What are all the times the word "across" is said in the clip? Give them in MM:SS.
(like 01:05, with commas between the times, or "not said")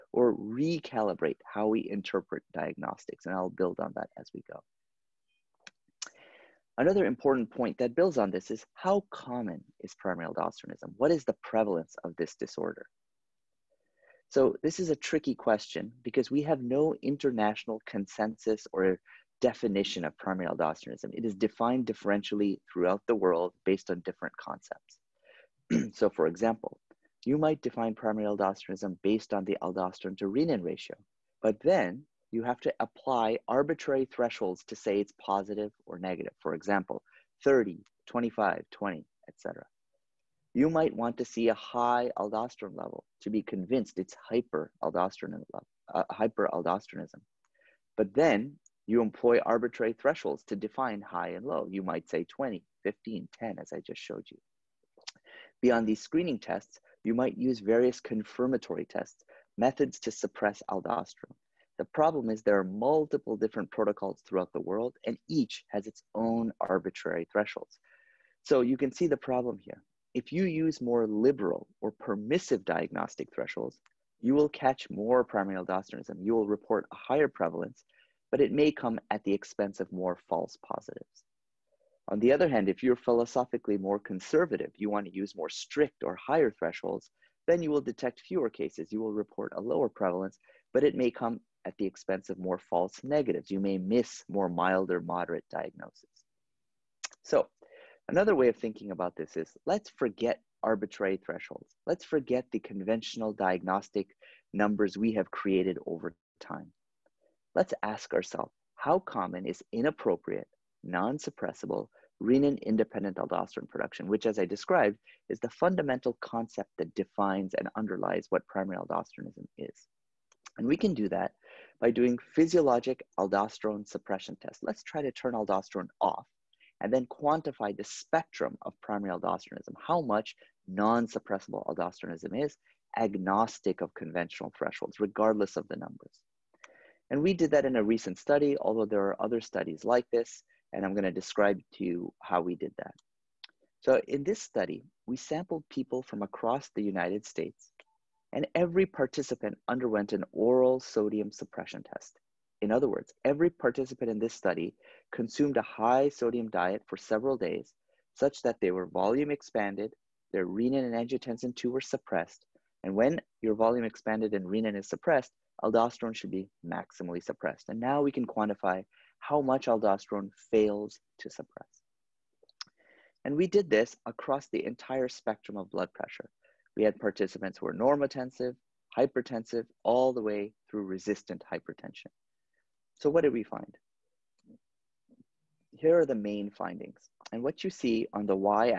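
02:26, 02:54.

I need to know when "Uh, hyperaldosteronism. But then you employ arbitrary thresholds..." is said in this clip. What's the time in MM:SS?
00:45.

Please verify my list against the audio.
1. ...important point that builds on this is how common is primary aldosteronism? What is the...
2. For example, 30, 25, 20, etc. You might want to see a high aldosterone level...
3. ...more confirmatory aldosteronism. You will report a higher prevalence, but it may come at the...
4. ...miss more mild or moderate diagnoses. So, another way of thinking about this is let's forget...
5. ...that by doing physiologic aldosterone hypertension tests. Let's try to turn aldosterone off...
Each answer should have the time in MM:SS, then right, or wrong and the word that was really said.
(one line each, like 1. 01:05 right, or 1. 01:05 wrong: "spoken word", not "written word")
1. 00:07 right
2. 00:36 right
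3. 01:14 wrong: "primary", not "confirmatory"
4. 01:33 right
5. 02:01 wrong: "suppression", not "hypertension".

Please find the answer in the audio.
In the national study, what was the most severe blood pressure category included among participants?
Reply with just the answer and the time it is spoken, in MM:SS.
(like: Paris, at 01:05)
resistant hypertension, at 03:00.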